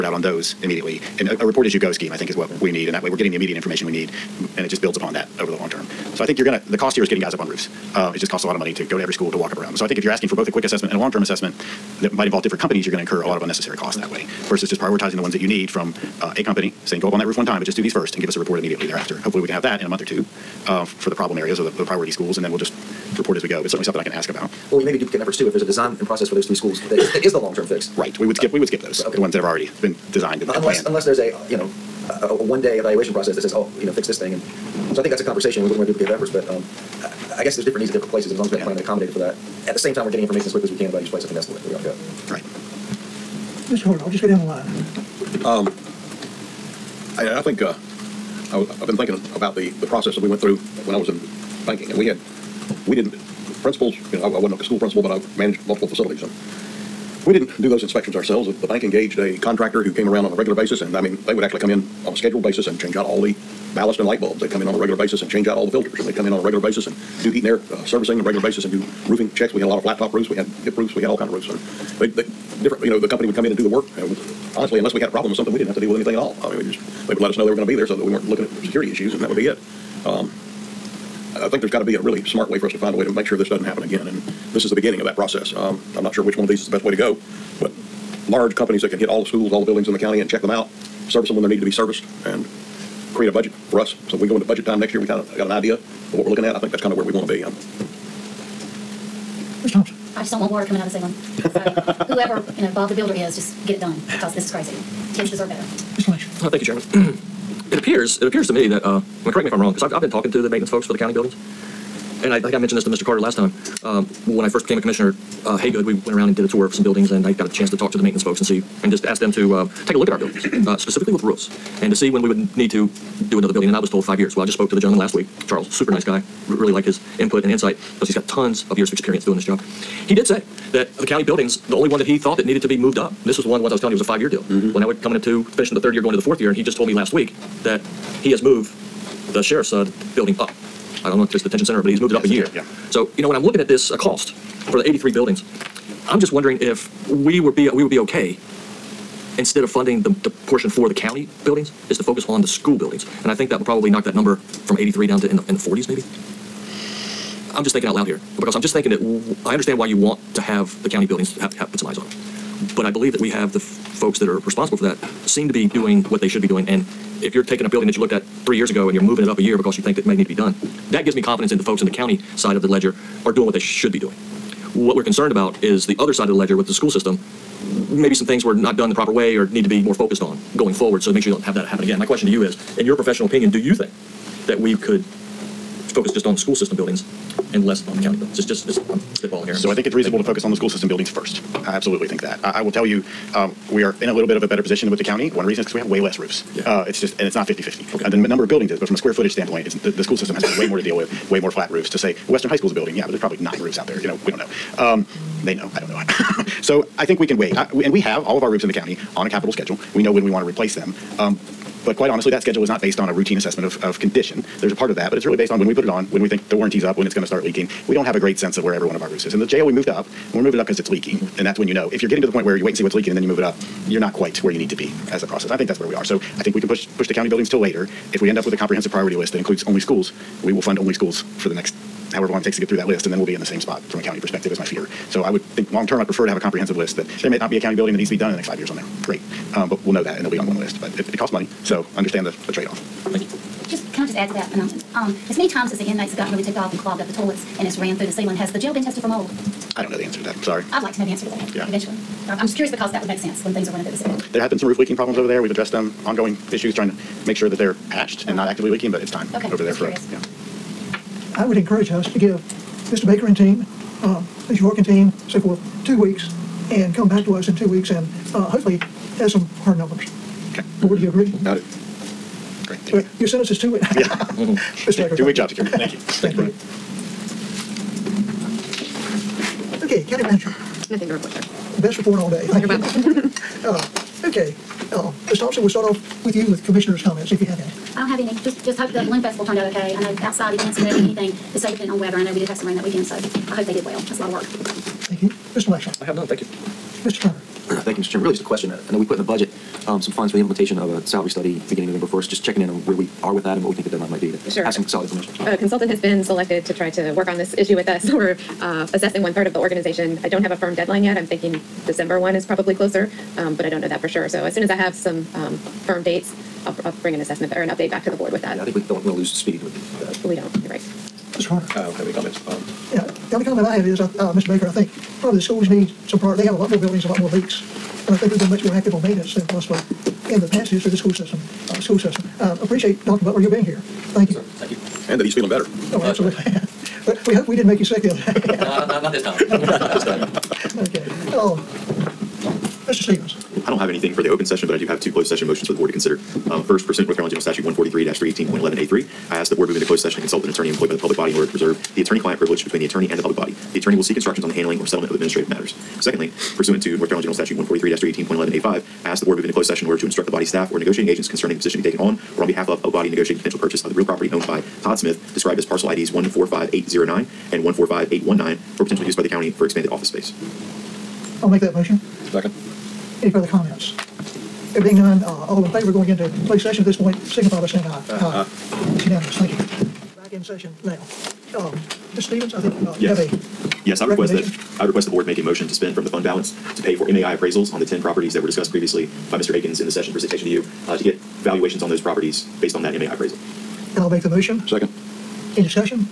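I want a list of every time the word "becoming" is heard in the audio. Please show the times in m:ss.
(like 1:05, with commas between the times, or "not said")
not said.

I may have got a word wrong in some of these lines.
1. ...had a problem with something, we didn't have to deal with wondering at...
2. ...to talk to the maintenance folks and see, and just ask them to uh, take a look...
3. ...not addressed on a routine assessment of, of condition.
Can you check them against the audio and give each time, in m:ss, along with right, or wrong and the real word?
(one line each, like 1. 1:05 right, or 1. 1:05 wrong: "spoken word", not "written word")
1. 1:15 wrong: "anything", not "wondering"
2. 1:57 right
3. 3:32 wrong: "based", not "addressed".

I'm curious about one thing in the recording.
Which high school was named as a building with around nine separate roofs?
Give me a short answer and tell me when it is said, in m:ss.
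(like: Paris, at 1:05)
Western High School, at 3:22.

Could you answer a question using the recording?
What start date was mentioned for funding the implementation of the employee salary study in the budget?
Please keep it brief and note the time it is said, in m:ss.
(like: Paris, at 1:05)
November 1st, at 5:01.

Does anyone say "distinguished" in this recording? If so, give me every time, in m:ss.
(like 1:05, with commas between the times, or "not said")
not said.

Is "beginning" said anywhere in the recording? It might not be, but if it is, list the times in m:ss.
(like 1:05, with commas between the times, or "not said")
1:24, 5:01.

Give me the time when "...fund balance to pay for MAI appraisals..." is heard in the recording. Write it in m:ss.
6:26.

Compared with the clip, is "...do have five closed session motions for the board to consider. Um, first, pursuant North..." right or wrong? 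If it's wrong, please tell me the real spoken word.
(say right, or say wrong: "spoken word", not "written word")
wrong: "two", not "five".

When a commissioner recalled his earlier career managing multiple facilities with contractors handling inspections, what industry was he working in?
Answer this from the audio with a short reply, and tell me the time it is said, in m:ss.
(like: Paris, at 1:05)
banking, at 0:51.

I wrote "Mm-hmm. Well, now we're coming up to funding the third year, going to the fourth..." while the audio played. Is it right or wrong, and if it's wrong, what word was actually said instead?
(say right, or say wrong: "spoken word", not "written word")
wrong: "finishing", not "funding".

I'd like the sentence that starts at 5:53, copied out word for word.
The attorney will seek instructions on the handling or settlement of administrative matters.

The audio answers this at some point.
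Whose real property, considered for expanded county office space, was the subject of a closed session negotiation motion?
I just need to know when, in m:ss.
6:04.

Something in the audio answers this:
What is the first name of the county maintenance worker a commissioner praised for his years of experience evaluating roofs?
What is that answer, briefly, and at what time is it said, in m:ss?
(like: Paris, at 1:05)
Charles, at 2:05.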